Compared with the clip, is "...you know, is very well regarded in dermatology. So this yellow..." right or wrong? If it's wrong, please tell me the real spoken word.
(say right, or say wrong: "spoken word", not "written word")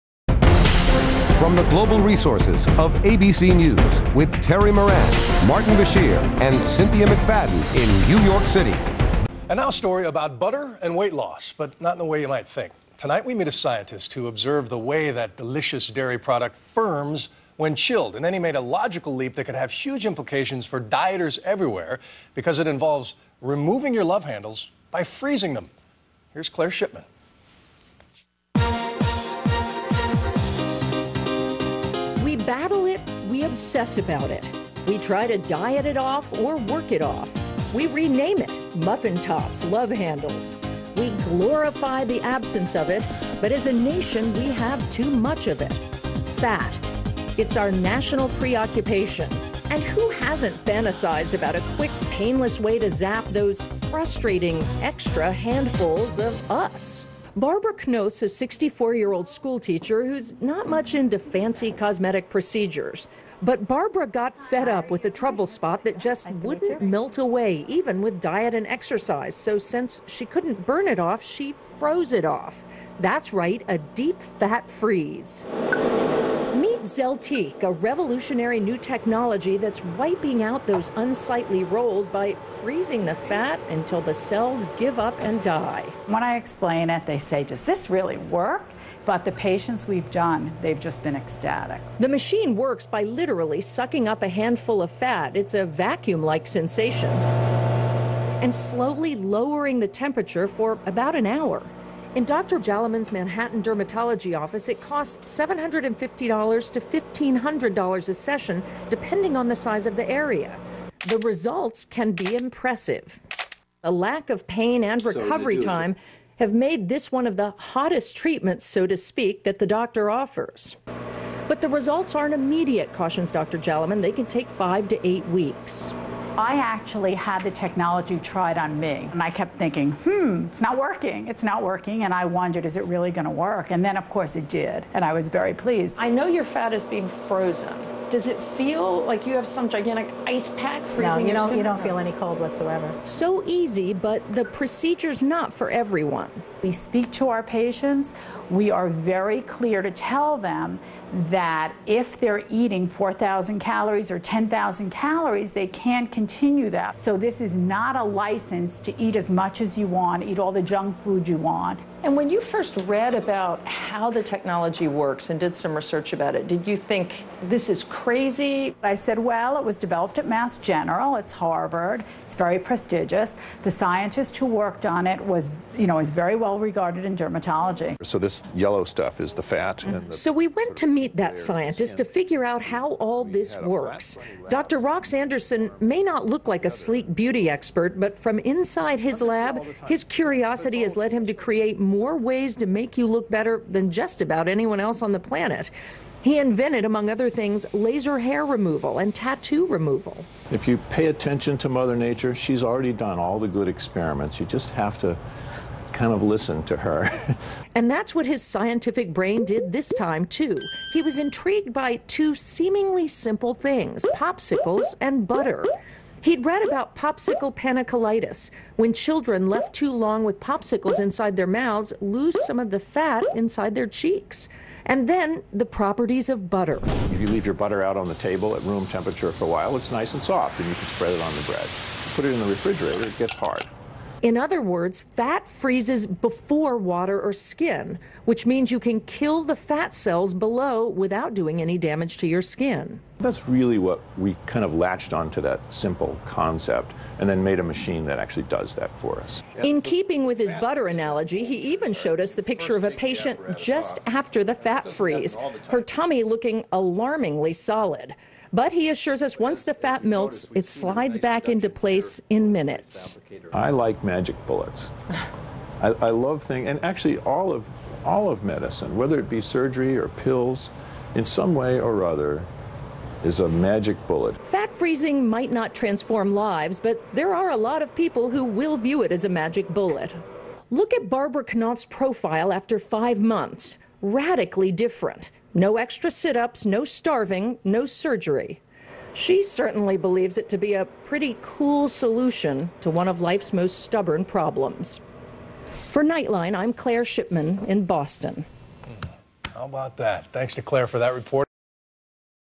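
right.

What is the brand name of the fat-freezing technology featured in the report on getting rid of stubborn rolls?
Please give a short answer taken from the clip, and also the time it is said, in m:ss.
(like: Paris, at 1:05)
Zeltiq, at 1:16.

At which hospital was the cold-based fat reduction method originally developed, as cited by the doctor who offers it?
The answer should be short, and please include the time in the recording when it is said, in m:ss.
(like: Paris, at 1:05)
Mass General, at 2:50.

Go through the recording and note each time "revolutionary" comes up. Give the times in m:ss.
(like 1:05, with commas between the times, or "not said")
1:17.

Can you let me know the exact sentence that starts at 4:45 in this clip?
No extra sit ups, no starving, no surgery.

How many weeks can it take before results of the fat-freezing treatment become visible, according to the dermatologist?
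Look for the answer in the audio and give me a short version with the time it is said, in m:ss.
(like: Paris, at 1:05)
5 to 8 weeks, at 2:04.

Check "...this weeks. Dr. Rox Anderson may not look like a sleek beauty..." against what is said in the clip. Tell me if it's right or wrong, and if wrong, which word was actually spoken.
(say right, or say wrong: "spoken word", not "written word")
wrong: "works", not "weeks".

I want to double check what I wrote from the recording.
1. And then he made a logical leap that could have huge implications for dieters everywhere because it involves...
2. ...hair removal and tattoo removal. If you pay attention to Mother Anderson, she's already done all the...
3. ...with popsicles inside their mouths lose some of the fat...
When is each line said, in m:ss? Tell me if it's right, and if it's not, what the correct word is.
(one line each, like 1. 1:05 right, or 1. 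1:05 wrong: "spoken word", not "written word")
1. 0:18 right
2. 3:18 wrong: "Nature", not "Anderson"
3. 3:40 right.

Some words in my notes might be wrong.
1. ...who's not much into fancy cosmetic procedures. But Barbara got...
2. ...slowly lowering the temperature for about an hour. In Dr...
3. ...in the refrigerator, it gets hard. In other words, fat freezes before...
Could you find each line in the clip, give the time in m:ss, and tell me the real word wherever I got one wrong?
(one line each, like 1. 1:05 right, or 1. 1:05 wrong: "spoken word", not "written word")
1. 1:00 right
2. 1:38 right
3. 3:52 right.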